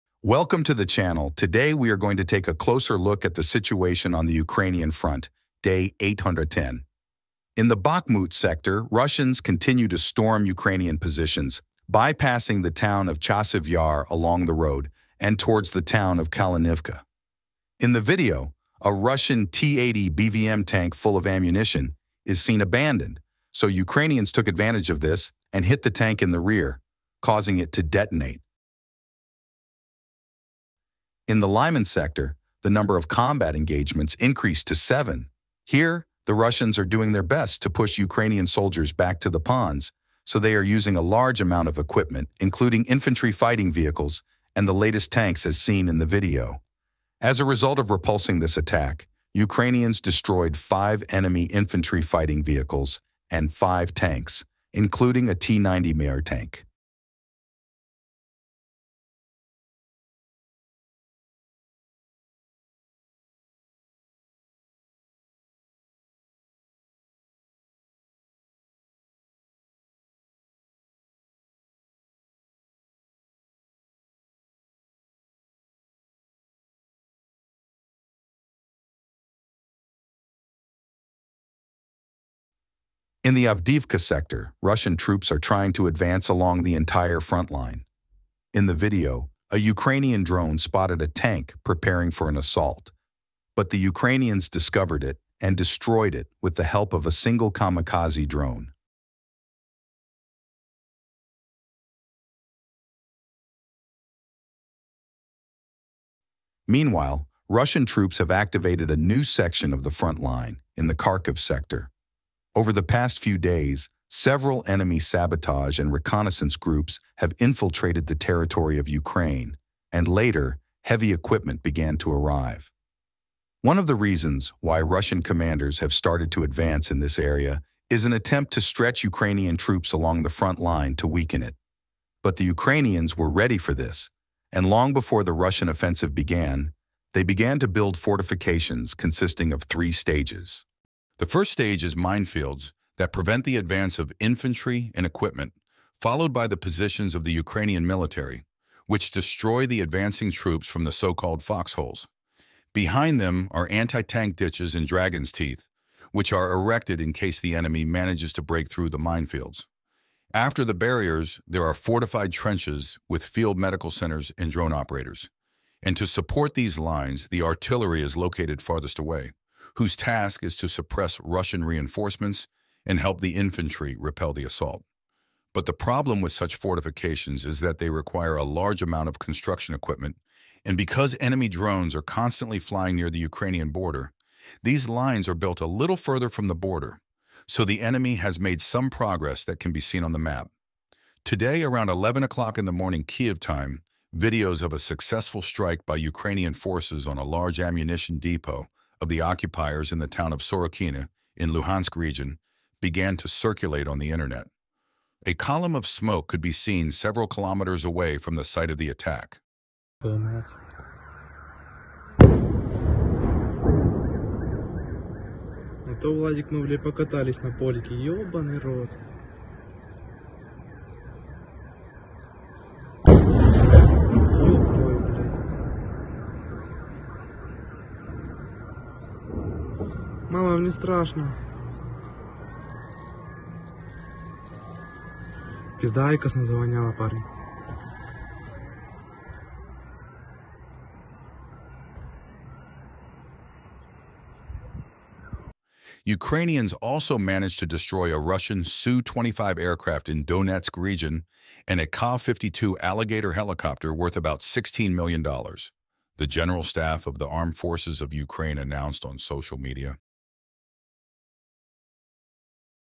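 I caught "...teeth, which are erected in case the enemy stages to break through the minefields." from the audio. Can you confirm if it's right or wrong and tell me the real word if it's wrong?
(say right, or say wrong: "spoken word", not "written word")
wrong: "manages", not "stages".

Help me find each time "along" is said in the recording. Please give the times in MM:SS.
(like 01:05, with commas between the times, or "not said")
00:14, 01:26, 02:09.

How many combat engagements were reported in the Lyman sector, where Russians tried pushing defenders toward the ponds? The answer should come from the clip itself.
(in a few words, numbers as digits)
7.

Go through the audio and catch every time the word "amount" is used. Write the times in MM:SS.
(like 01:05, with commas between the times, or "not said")
00:41, 02:58.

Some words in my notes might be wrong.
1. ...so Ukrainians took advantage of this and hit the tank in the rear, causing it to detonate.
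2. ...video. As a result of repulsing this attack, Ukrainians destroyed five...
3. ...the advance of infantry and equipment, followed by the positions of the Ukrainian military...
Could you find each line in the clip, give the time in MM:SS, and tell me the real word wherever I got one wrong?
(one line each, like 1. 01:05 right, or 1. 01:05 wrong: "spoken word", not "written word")
1. 00:23 right
2. 00:46 right
3. 02:23 right.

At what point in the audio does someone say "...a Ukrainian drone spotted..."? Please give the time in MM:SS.
01:29.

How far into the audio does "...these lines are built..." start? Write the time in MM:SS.
03:04.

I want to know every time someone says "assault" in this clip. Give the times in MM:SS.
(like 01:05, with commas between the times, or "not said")
01:32, 02:54.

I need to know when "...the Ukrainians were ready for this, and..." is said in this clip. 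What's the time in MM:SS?
02:12.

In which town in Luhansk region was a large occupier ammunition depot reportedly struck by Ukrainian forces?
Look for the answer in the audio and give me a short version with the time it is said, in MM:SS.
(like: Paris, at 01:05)
Sorokina, at 03:20.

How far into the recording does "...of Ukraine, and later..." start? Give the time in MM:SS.
01:58.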